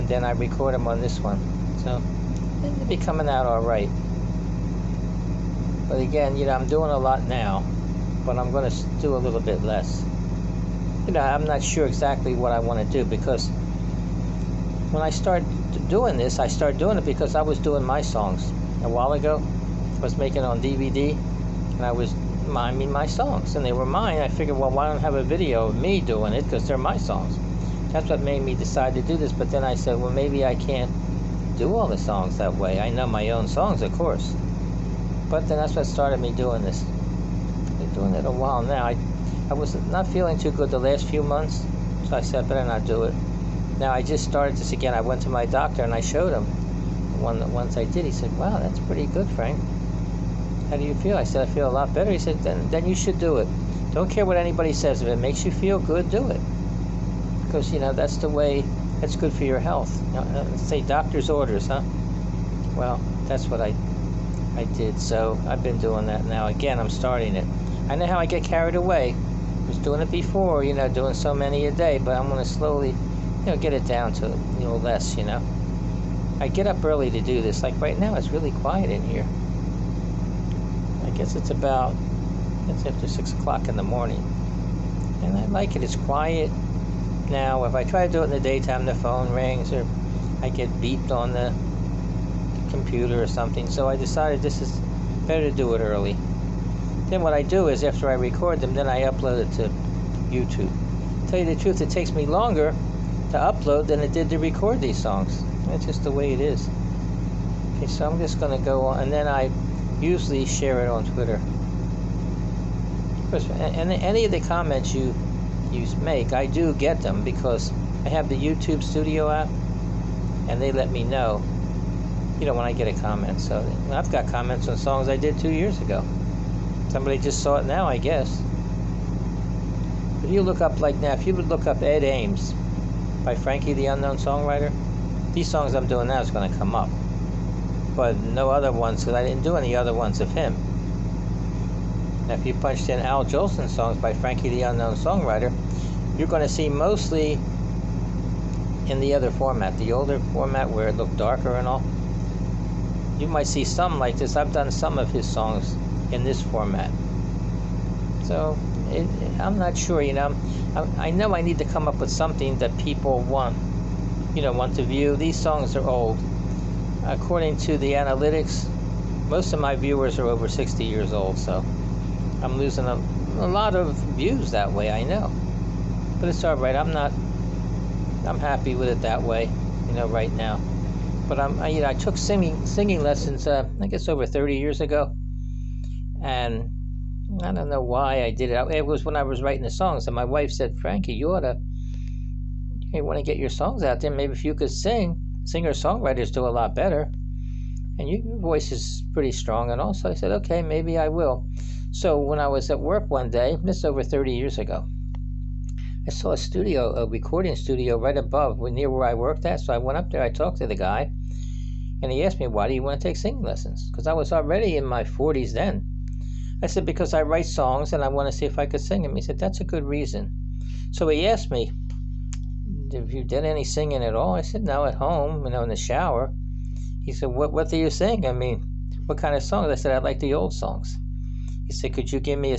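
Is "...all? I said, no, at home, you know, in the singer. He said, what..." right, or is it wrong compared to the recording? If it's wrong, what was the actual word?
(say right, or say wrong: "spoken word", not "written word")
wrong: "shower", not "singer".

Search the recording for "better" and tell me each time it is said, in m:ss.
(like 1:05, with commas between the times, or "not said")
0:42, 0:51, 1:35, 3:16.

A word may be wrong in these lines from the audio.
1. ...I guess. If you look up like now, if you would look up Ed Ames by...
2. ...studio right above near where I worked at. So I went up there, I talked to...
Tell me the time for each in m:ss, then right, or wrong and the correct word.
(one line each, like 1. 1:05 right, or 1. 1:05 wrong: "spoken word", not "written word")
1. 2:07 right
2. 3:27 right.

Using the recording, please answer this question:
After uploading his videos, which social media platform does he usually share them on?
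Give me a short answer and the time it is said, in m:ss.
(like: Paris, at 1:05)
Twitter, at 1:51.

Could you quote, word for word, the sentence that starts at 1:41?
Tell you the truth, it takes me longer to upload than it did to record these songs.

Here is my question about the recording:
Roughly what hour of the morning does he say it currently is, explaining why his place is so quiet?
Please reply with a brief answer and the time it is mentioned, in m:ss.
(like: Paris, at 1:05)
6 o'clock, at 1:23.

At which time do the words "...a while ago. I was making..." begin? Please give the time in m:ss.
0:18.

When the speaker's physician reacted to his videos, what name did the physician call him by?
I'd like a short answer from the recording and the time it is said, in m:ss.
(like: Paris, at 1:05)
Frank, at 0:49.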